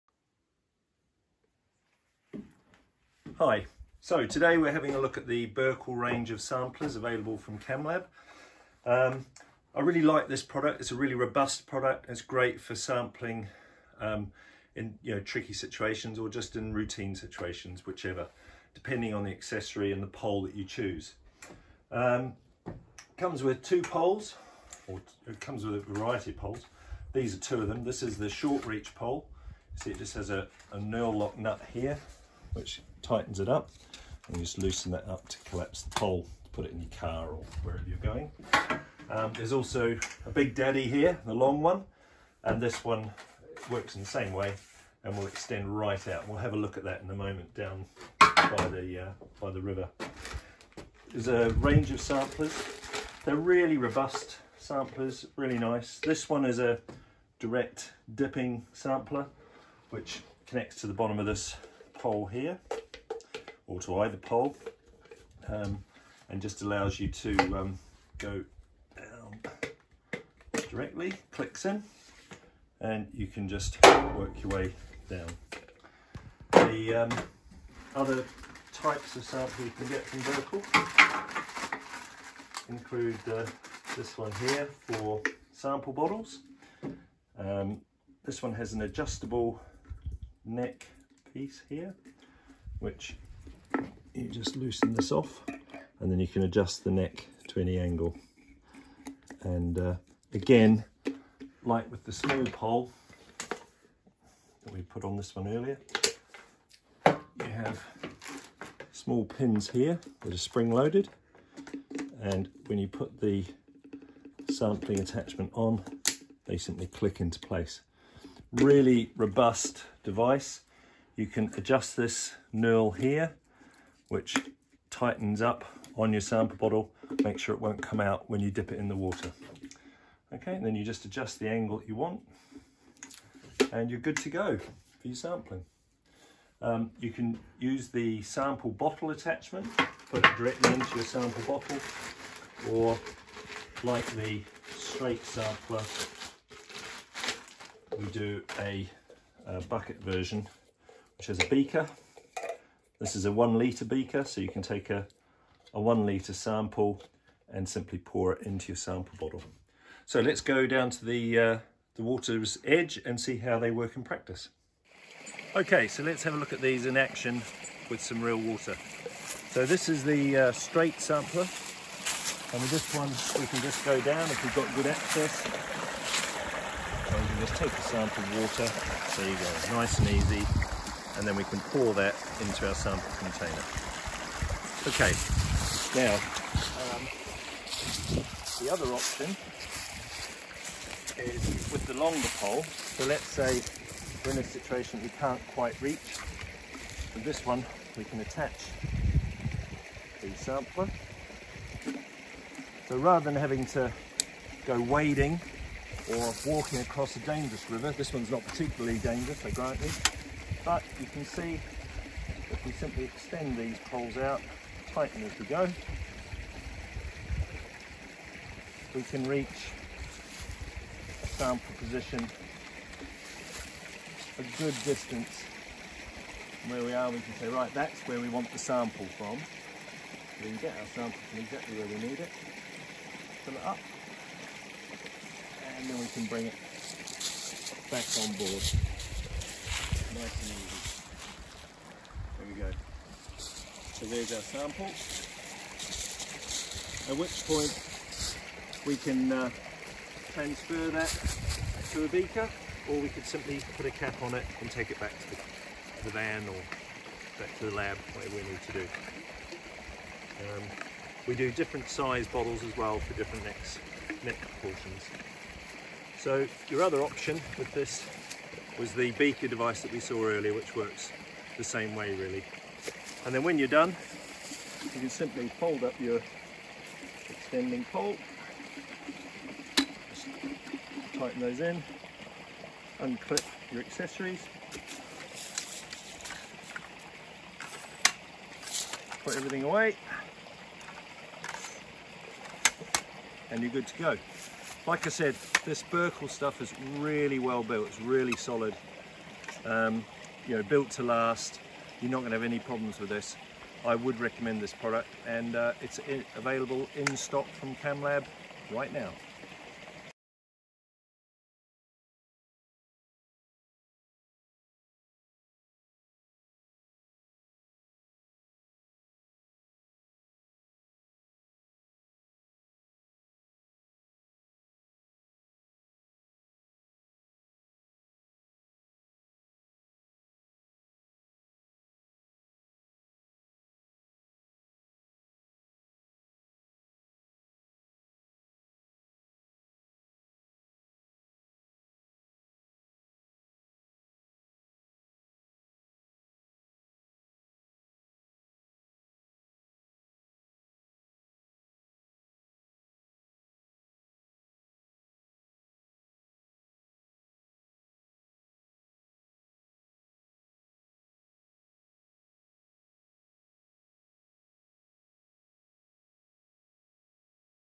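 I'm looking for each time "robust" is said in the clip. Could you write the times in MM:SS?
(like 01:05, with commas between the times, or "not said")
00:11, 00:53, 01:59.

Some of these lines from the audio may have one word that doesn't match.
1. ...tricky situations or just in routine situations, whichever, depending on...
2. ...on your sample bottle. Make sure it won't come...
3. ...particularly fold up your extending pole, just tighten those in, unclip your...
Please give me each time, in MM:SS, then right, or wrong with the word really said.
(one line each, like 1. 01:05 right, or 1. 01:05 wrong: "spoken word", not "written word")
1. 00:15 right
2. 02:05 right
3. 04:35 wrong: "simply", not "particularly".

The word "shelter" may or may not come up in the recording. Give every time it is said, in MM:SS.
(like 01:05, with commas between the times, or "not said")
not said.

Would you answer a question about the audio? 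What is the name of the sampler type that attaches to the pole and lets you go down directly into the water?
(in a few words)
direct dipping sampler.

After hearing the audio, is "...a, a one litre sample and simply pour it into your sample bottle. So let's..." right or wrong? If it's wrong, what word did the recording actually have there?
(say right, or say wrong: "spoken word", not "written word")
right.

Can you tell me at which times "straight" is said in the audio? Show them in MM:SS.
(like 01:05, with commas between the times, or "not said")
02:24, 02:50.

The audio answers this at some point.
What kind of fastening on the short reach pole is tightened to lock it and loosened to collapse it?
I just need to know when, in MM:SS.
00:30.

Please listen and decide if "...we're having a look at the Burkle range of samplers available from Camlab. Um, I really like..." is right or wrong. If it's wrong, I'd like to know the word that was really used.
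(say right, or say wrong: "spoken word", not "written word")
right.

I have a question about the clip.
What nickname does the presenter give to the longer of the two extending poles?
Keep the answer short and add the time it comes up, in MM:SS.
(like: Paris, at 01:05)
big daddy, at 00:40.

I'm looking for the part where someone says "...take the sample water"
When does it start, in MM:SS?
02:57.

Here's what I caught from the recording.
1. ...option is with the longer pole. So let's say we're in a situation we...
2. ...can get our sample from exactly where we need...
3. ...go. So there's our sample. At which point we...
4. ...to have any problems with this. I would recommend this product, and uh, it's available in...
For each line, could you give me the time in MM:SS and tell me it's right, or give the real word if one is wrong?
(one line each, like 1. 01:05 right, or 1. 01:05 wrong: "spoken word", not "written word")
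1. 03:08 right
2. 03:50 right
3. 04:02 right
4. 05:02 right.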